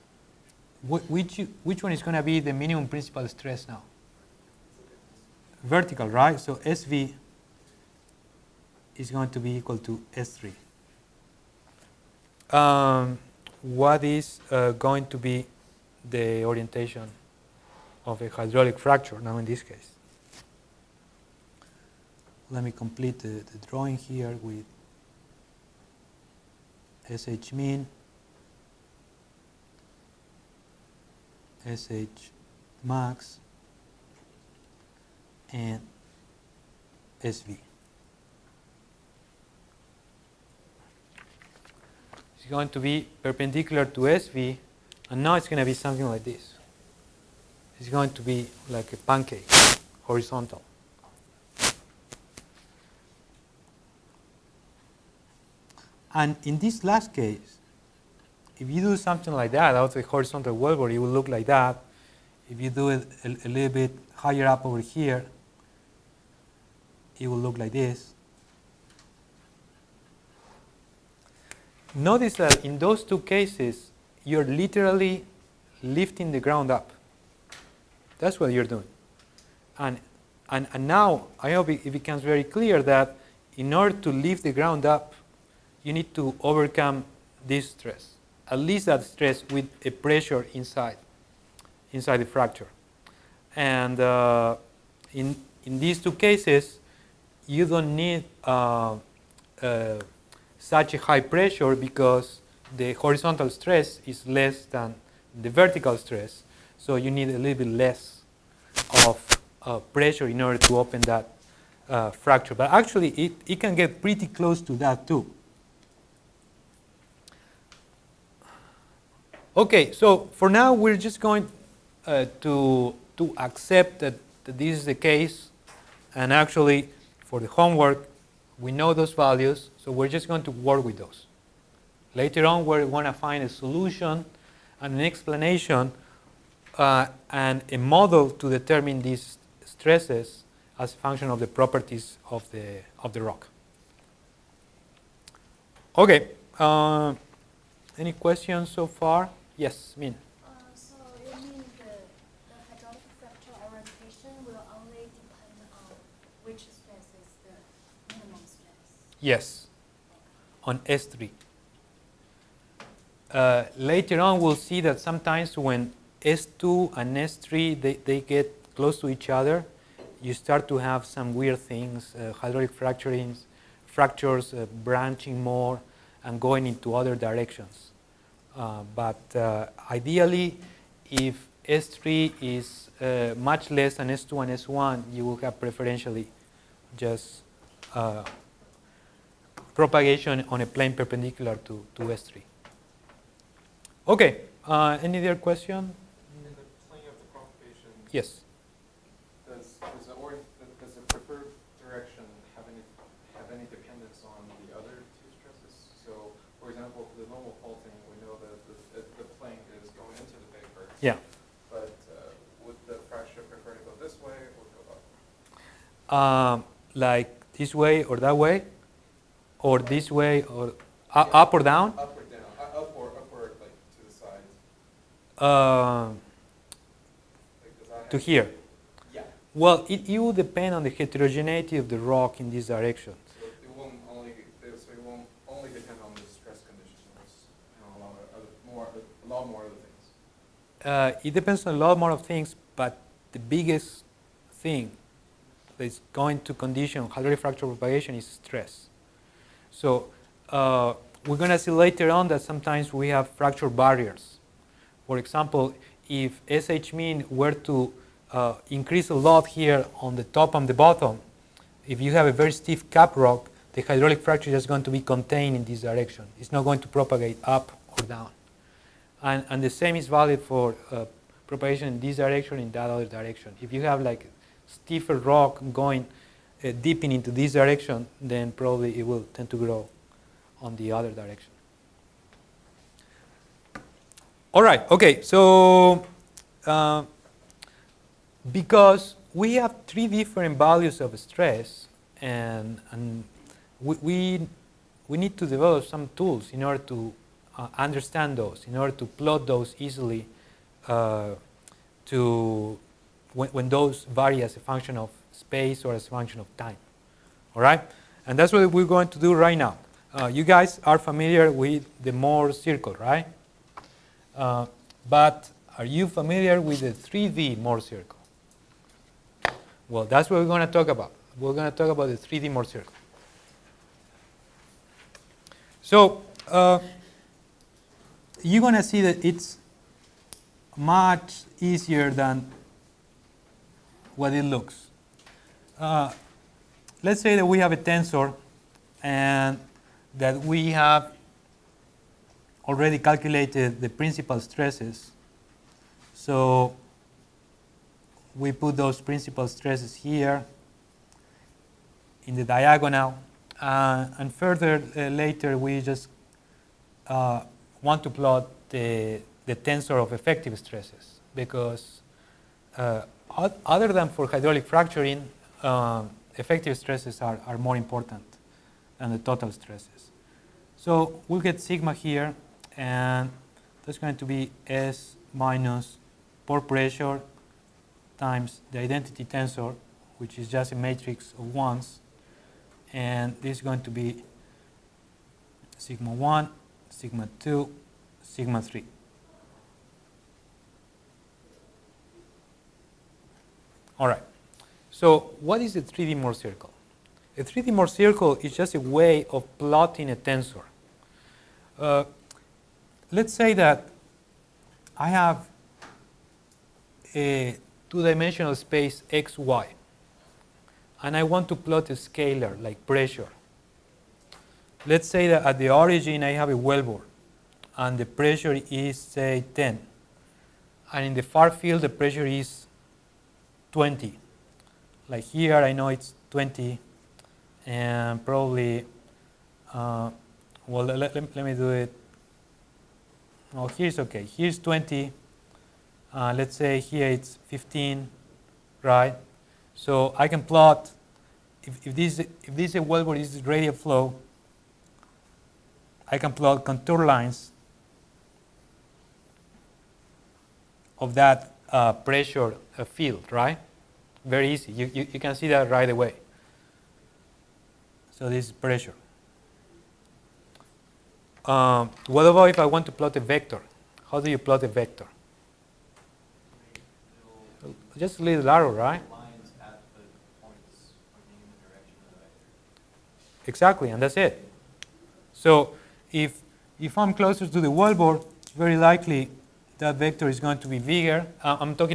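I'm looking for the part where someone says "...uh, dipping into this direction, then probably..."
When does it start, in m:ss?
4:36.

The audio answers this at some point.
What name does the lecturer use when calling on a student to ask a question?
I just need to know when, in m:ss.
2:29.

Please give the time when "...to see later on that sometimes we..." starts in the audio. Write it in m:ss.
4:11.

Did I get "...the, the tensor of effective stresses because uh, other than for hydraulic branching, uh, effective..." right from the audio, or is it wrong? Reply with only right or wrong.
wrong.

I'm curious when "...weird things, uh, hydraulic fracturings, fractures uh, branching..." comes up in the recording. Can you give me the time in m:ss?
2:51.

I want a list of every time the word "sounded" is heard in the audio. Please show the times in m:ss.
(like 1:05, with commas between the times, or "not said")
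not said.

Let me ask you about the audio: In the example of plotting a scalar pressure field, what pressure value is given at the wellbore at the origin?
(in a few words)
10.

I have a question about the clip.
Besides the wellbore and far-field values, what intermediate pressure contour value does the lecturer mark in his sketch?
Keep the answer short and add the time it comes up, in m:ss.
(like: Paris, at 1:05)
15, at 7:17.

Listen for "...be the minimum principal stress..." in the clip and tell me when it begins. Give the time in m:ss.
0:02.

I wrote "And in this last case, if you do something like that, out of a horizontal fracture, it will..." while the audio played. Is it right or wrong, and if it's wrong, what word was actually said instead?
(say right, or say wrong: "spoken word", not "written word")
wrong: "wellbore", not "fracture".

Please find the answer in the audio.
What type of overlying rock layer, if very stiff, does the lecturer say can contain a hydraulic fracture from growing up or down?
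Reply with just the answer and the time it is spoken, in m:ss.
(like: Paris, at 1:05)
cap rock, at 4:22.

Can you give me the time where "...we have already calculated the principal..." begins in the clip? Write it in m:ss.
5:40.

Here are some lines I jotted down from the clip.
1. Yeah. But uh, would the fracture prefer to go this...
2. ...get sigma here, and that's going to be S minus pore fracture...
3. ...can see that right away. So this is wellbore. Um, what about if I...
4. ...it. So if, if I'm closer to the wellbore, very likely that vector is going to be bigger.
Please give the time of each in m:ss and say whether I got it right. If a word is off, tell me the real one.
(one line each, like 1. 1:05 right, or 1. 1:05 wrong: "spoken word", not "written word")
1. 3:31 right
2. 6:11 wrong: "pressure", not "fracture"
3. 7:35 wrong: "pressure", not "wellbore"
4. 7:54 right.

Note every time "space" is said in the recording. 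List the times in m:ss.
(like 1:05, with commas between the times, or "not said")
5:05, 6:48.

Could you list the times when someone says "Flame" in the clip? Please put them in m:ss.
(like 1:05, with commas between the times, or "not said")
not said.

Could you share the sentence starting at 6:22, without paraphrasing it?
And this is going to be sigma 1, sigma 2, sigma 3.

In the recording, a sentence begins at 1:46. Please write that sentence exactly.
So you need a little bit less of uh, pressure in order to open that uh, fracture.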